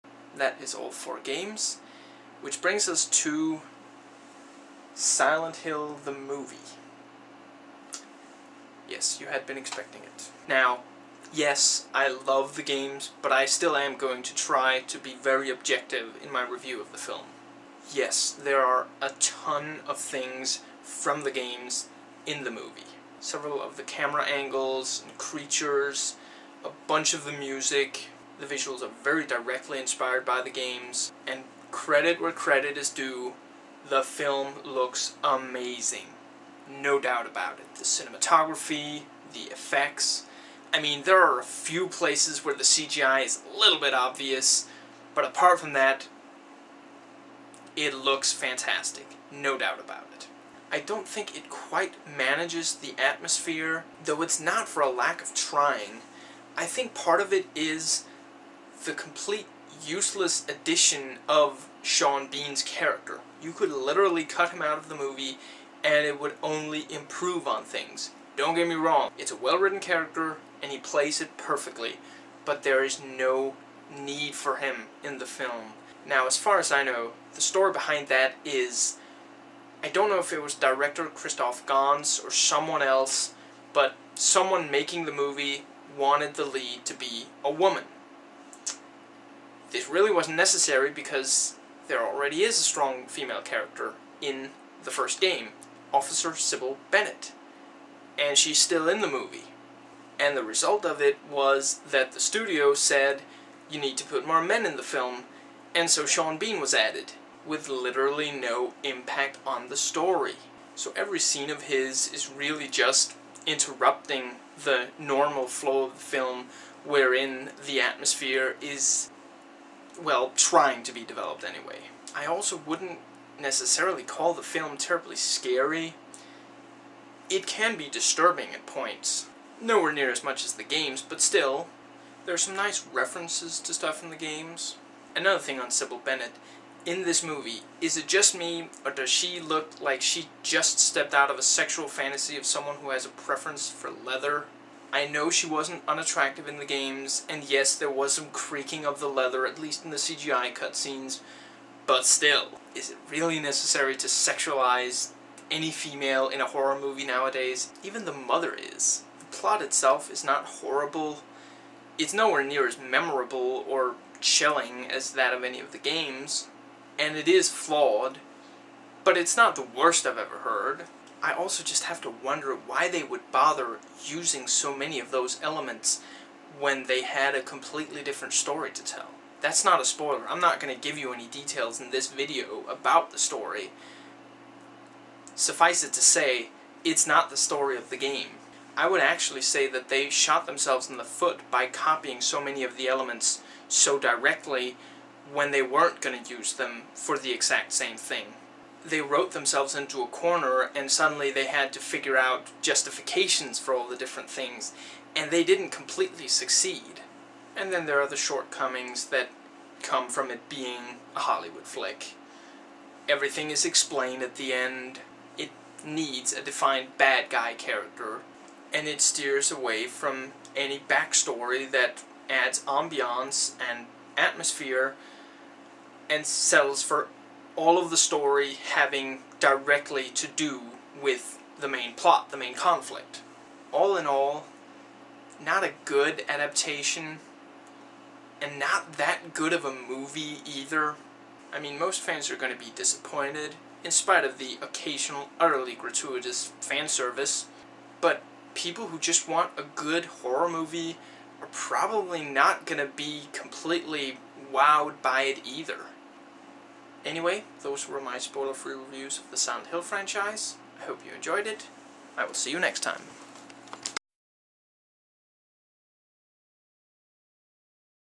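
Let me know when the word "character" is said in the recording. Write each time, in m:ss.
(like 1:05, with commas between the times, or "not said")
1:02, 1:09, 1:33, 3:37.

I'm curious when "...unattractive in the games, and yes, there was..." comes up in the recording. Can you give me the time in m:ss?
2:25.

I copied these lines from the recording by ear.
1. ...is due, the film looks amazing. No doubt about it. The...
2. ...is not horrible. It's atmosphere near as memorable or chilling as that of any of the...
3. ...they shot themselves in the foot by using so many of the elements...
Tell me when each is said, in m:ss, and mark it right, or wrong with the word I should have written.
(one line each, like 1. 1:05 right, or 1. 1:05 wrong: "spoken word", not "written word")
1. 0:32 right
2. 2:40 wrong: "nowhere", not "atmosphere"
3. 3:09 wrong: "copying", not "using".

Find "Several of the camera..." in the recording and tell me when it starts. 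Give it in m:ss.
0:23.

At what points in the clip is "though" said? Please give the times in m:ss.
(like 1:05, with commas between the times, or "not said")
0:54.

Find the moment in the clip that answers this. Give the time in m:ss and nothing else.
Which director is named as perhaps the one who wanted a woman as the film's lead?
1:21.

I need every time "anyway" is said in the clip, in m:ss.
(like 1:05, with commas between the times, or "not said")
2:01, 4:17.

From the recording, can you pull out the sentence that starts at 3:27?
And then there are the shortcomings that come from it being a Hollywood flick.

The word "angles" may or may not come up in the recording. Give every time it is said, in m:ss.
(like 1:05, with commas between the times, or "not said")
0:24.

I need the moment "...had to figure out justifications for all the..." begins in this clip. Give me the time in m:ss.
3:21.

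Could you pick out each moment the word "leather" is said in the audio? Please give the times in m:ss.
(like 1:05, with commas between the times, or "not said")
2:23, 2:29.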